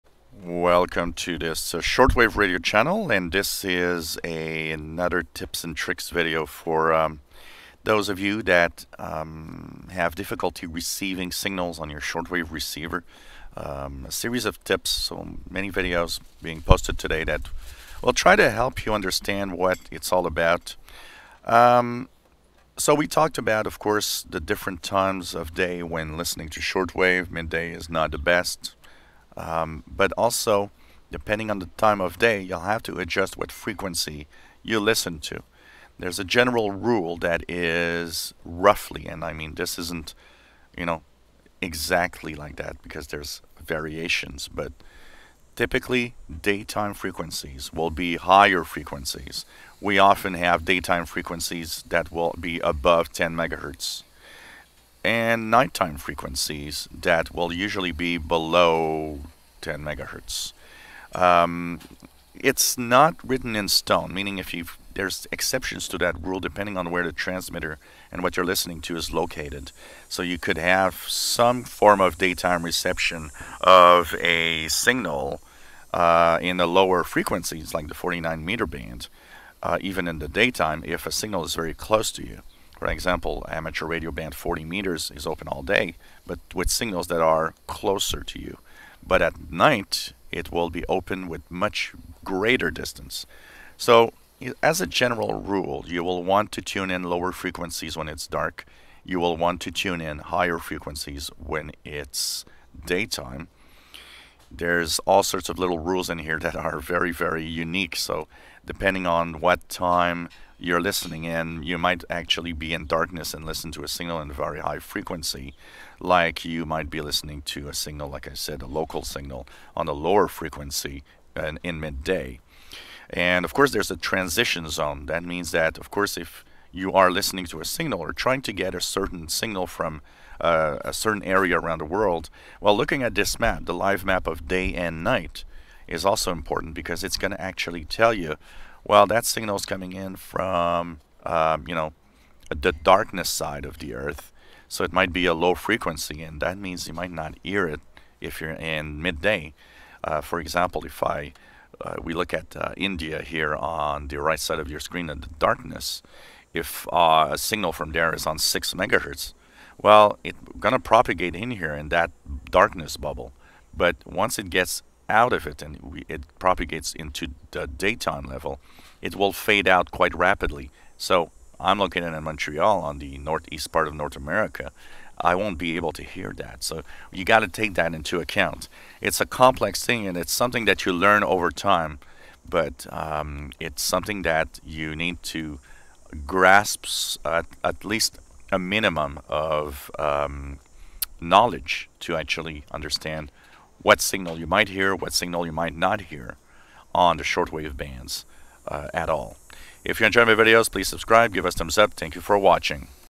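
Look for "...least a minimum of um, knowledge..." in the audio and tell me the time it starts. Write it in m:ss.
3:07.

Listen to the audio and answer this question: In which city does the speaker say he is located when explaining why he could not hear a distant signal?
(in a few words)
Montreal.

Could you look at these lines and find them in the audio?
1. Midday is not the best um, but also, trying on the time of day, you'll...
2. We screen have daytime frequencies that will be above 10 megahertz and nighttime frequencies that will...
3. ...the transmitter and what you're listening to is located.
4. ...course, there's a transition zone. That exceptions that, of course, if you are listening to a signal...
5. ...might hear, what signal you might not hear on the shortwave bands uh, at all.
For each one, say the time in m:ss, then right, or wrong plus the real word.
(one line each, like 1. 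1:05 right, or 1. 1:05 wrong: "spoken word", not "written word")
1. 0:27 wrong: "depending", not "trying"
2. 0:49 wrong: "often", not "screen"
3. 1:07 right
4. 2:03 wrong: "means", not "exceptions"
5. 3:14 right.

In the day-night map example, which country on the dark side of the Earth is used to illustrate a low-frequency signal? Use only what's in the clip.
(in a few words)
India.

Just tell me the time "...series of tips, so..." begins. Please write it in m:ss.
0:14.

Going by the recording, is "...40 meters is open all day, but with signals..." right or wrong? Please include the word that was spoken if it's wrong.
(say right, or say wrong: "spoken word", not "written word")
right.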